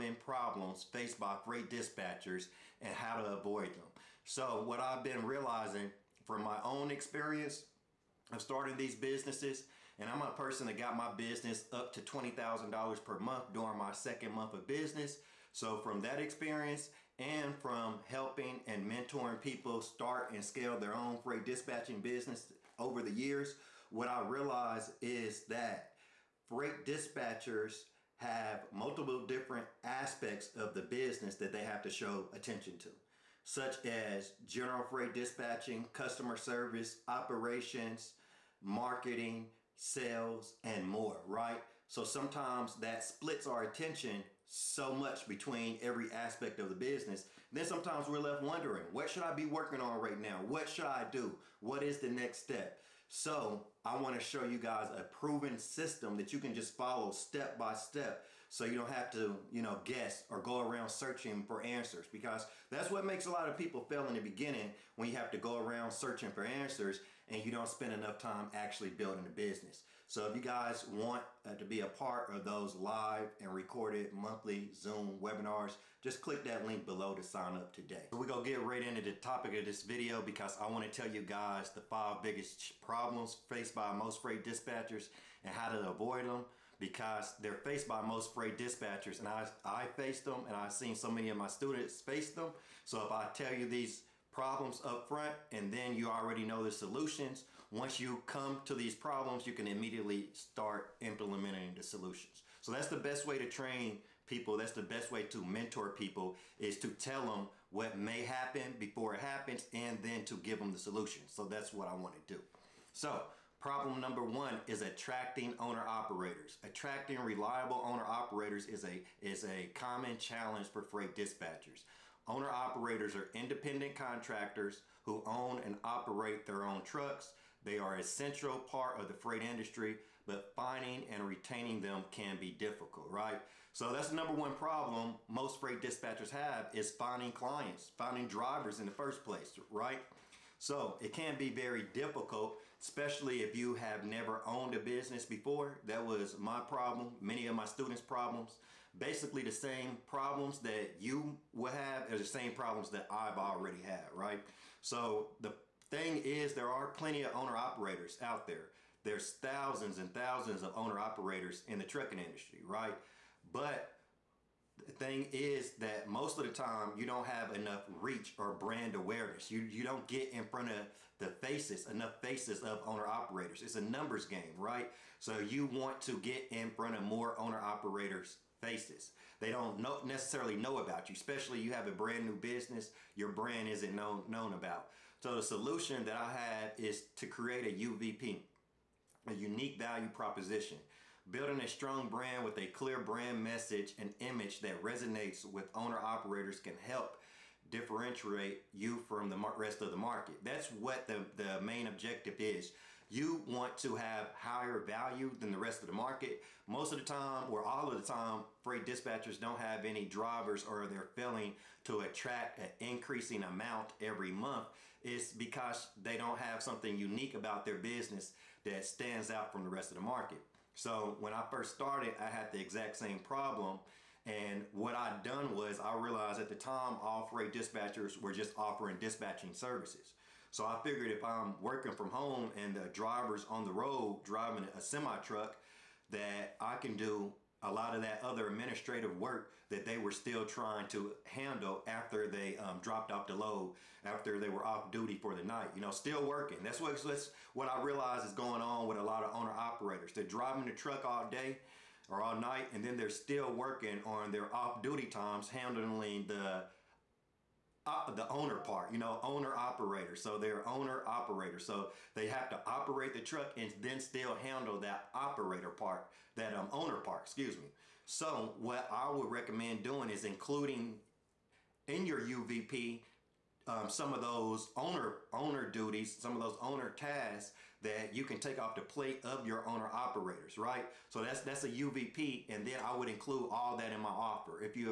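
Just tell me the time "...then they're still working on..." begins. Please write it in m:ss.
4:12.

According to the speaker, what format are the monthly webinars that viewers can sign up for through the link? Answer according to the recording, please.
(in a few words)
Zoom.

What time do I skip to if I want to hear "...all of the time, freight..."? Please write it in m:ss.
3:27.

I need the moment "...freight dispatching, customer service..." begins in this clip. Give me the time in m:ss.
0:34.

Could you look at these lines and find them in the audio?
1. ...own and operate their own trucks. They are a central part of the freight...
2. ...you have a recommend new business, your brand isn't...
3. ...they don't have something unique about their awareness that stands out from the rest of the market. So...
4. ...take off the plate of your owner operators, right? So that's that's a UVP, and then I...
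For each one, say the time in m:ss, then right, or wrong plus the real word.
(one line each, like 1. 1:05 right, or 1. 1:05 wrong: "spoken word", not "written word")
1. 2:05 right
2. 3:01 wrong: "brand", not "recommend"
3. 3:35 wrong: "business", not "awareness"
4. 4:38 right.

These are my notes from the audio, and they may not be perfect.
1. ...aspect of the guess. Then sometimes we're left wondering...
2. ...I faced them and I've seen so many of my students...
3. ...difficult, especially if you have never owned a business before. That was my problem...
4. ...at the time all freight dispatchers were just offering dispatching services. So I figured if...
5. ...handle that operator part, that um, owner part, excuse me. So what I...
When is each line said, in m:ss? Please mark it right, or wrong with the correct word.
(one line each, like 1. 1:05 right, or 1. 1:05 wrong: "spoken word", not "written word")
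1. 0:46 wrong: "business", not "guess"
2. 1:29 right
3. 2:21 right
4. 3:46 right
5. 4:24 right.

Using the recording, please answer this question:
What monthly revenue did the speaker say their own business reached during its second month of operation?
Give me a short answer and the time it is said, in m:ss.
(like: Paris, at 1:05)
$20,000, at 0:12.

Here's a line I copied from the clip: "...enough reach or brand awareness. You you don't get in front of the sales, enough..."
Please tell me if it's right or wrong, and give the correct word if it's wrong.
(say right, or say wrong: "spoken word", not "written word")
wrong: "faces", not "sales".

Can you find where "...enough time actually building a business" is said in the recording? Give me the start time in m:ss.
1:07.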